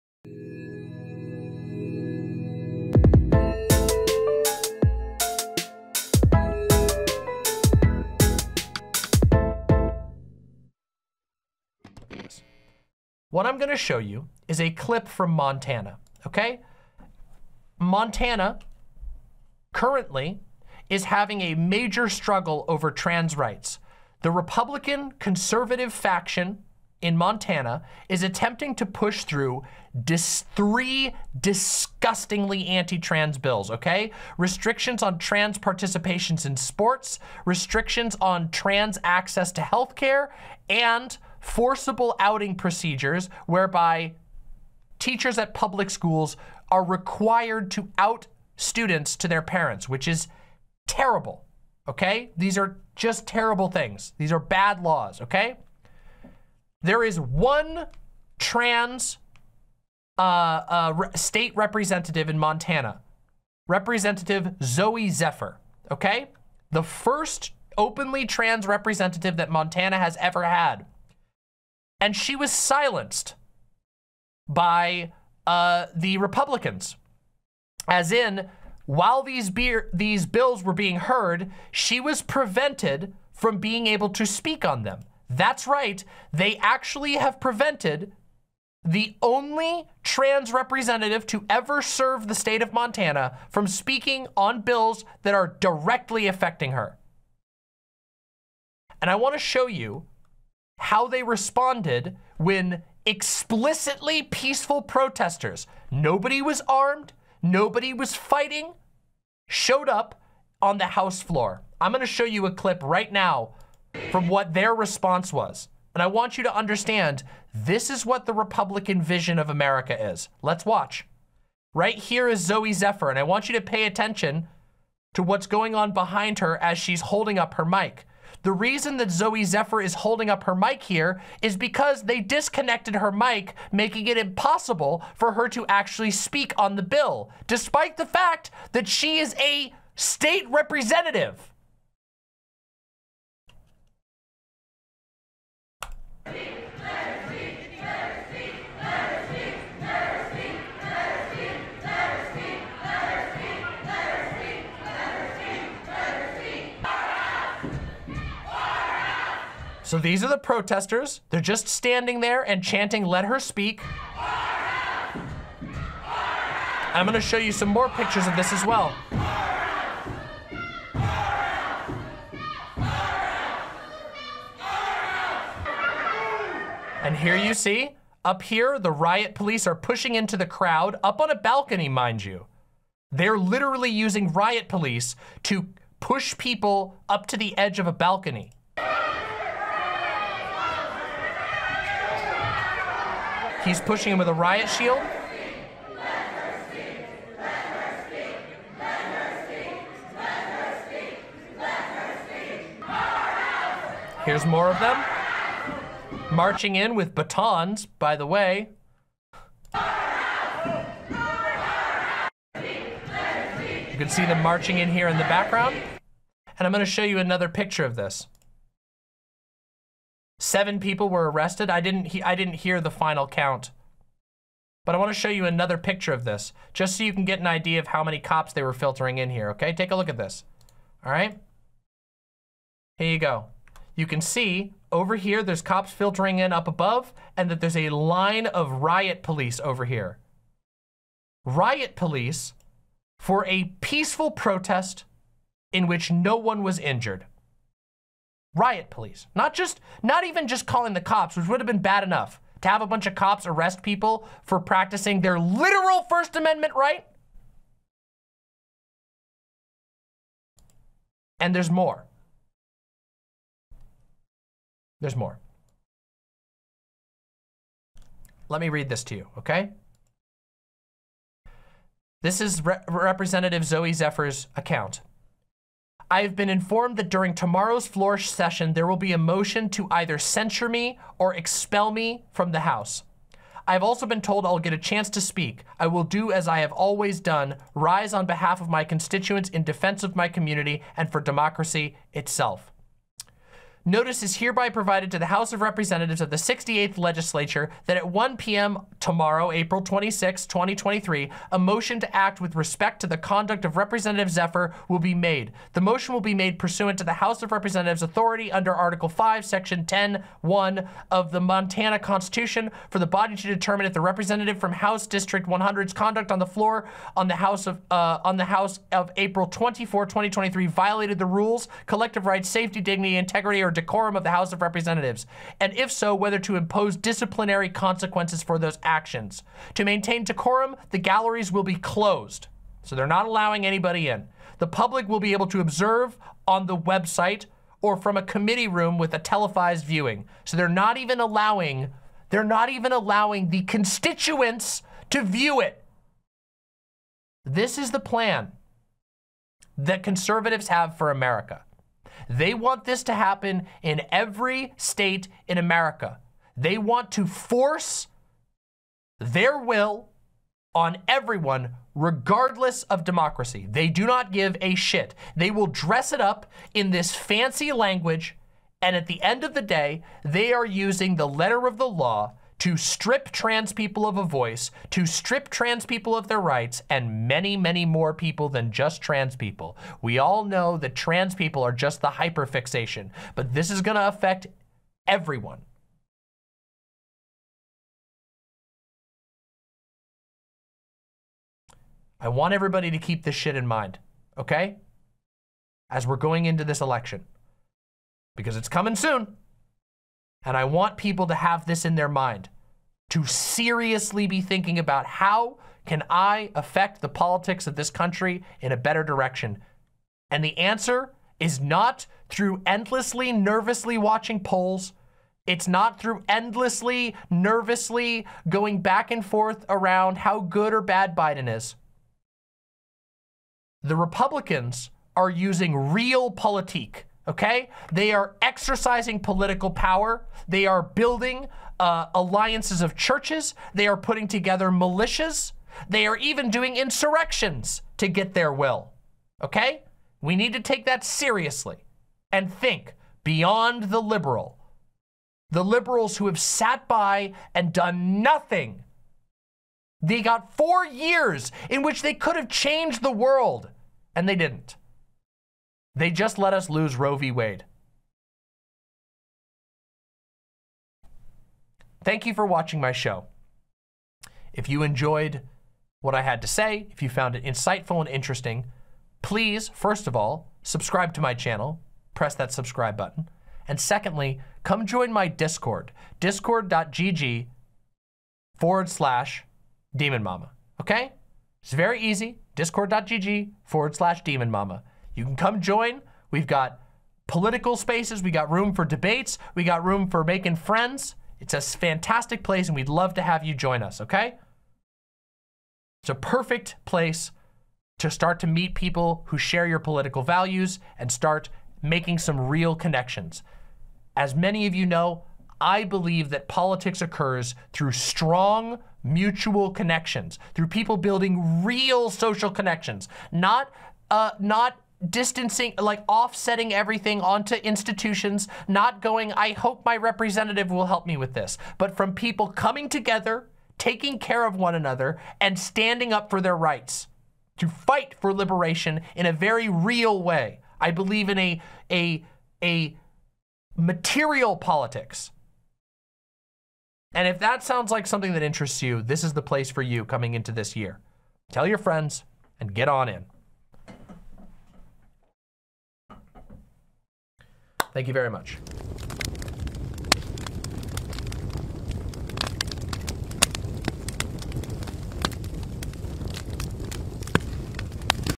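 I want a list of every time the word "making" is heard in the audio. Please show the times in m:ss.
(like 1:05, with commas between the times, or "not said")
2:13, 8:10, 8:21.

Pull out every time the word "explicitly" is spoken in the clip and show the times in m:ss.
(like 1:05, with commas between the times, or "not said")
1:43.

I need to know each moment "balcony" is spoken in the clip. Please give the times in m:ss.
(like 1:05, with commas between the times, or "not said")
3:01, 3:07.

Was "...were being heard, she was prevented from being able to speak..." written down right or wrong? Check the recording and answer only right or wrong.
right.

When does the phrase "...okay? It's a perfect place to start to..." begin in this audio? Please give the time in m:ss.
8:14.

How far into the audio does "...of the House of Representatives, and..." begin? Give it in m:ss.
5:24.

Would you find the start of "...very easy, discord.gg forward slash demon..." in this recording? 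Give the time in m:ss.
8:01.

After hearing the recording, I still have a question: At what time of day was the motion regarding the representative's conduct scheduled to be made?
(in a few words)
1 p.m.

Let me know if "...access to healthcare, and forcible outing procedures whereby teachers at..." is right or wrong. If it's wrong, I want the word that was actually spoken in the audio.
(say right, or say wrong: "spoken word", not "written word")
right.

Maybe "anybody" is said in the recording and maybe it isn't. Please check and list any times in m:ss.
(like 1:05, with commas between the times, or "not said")
5:33.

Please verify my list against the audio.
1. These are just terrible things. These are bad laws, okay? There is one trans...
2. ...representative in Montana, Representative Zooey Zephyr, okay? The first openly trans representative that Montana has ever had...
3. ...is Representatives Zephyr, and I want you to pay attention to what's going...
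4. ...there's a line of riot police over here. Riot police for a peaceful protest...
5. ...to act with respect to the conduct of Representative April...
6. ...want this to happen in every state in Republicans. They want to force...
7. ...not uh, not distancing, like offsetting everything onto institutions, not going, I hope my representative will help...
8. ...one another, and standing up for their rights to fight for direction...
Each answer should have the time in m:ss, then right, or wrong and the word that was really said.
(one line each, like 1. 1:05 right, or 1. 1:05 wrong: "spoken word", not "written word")
1. 0:52 right
2. 1:01 right
3. 2:02 wrong: "Zooey", not "Representatives"
4. 3:57 right
5. 5:01 wrong: "Zephyr", not "April"
6. 5:52 wrong: "America", not "Republicans"
7. 8:33 right
8. 8:44 wrong: "liberation", not "direction".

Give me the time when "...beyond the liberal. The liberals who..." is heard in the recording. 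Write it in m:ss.
7:23.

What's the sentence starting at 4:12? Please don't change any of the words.
To have a bunch of cops arrest people for practicing their literal First Amendment right?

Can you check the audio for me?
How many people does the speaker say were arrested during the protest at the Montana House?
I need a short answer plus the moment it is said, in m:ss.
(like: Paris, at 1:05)
7, at 3:40.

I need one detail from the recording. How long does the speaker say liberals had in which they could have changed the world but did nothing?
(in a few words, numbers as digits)
4 years.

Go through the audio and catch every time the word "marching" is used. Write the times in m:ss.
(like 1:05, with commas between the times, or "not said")
3:26, 3:34.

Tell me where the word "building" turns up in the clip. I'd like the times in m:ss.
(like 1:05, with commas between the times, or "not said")
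7:10, 8:30.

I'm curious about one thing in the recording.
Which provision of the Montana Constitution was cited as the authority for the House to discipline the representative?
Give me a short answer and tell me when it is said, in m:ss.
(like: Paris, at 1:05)
Article 5, Section 10.1, at 5:08.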